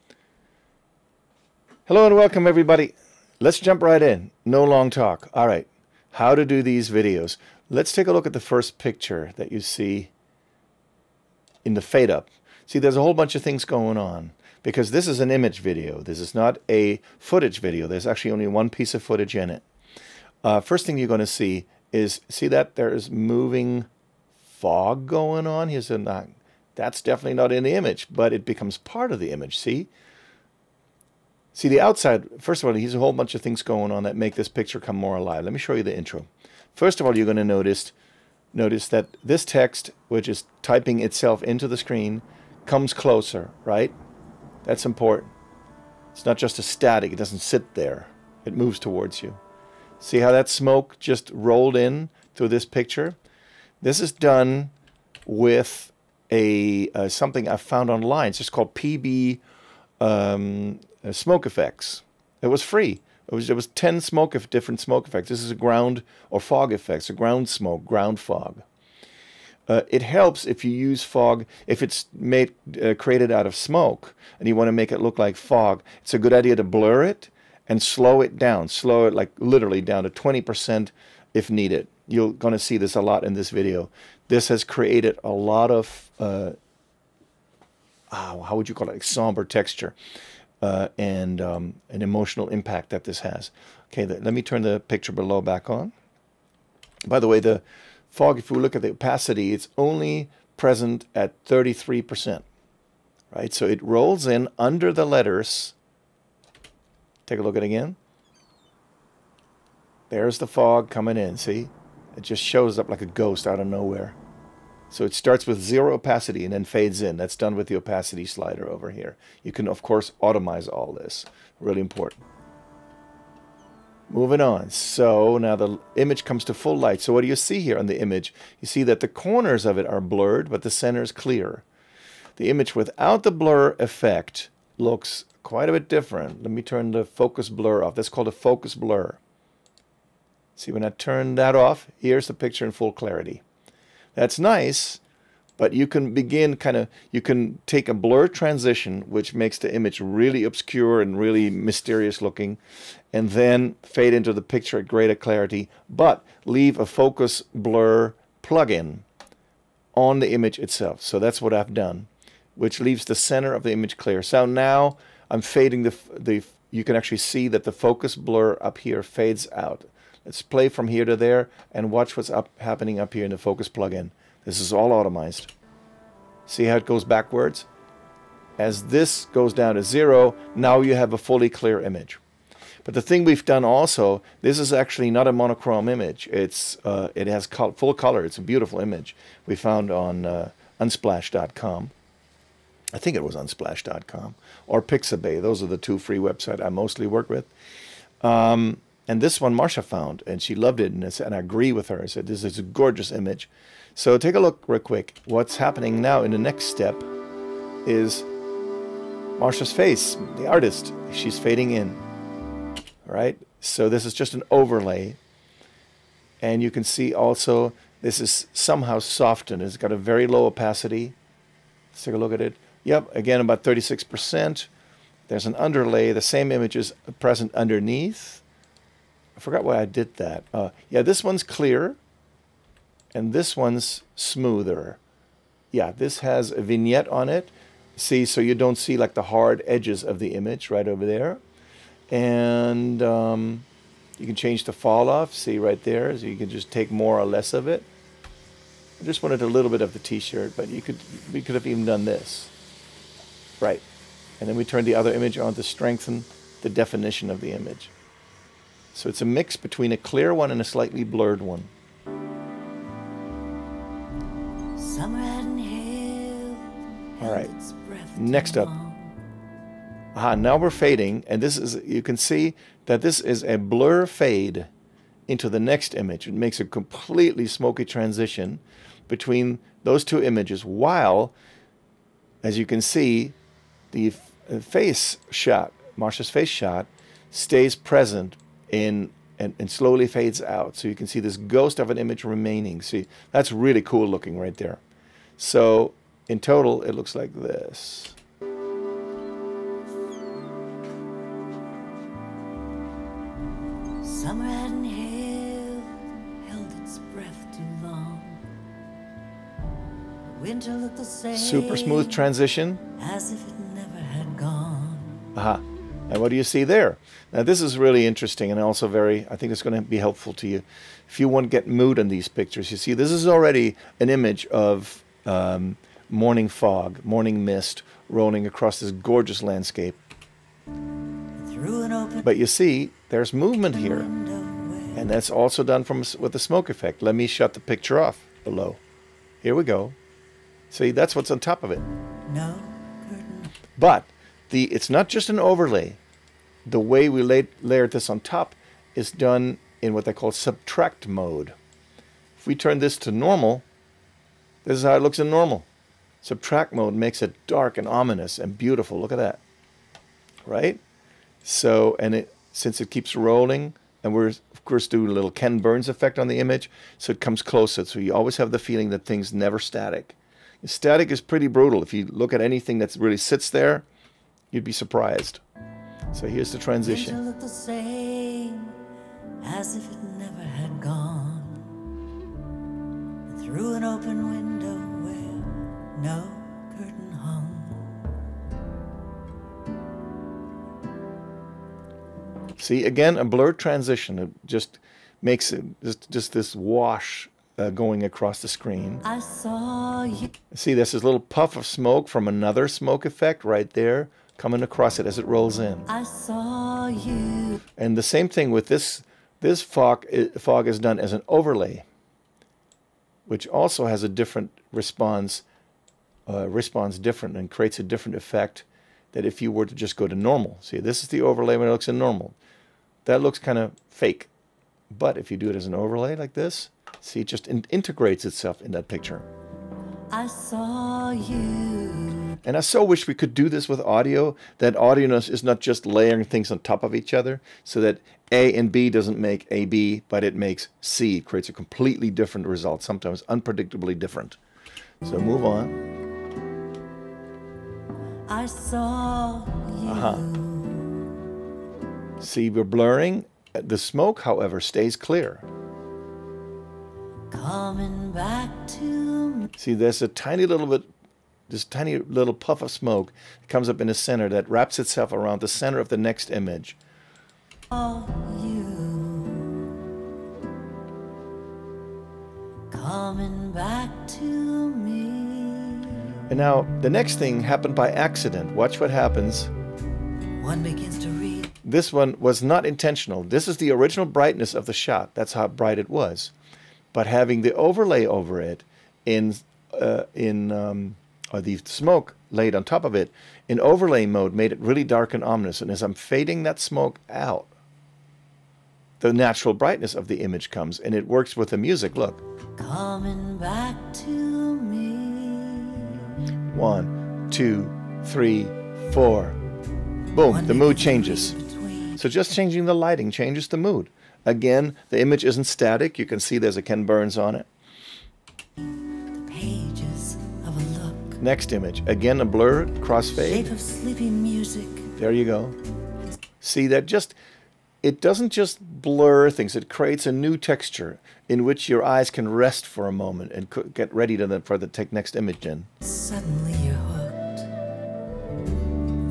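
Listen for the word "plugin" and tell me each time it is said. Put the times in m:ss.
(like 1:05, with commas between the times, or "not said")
2:38, 2:53.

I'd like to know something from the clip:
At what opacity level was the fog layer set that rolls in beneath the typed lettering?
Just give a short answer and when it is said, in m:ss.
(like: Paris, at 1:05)
33%, at 1:41.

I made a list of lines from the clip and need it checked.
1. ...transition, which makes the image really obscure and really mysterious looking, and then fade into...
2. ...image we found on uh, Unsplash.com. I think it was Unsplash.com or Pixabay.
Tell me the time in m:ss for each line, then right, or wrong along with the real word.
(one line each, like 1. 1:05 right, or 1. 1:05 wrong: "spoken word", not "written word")
1. 2:28 right
2. 3:08 right.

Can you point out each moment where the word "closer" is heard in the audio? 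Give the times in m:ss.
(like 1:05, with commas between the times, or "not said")
0:42, 6:07.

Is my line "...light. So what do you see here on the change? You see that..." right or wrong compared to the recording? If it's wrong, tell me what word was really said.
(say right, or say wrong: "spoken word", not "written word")
wrong: "image", not "change".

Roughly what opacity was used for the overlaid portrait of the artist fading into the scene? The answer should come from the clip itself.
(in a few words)
36%.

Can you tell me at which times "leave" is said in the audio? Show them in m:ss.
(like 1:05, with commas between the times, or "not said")
2:36, 2:42.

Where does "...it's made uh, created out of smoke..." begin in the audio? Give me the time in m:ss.
1:11.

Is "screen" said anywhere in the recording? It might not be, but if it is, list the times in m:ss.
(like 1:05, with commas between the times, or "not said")
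0:41, 6:38.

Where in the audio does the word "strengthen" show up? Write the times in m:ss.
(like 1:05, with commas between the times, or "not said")
4:15.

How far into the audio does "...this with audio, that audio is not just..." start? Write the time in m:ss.
7:13.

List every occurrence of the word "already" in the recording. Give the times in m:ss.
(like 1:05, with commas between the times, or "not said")
5:23.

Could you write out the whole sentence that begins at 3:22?
I said, this is a gorgeous image.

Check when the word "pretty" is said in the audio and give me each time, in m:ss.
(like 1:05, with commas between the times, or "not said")
6:11.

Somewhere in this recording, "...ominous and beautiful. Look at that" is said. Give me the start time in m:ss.
5:57.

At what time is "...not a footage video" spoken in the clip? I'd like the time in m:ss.
0:16.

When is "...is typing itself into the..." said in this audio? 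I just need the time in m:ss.
0:40.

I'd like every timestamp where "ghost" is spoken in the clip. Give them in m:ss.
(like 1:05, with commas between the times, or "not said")
1:53, 4:51.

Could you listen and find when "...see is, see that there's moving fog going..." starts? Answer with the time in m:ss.
0:21.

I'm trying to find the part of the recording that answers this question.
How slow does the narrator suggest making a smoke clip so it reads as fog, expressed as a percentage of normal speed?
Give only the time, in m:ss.
1:20.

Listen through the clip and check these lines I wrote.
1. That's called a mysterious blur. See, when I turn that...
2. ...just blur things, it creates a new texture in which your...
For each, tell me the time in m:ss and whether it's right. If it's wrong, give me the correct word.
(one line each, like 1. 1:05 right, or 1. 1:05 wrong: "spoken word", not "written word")
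1. 2:17 wrong: "focus", not "mysterious"
2. 8:48 right.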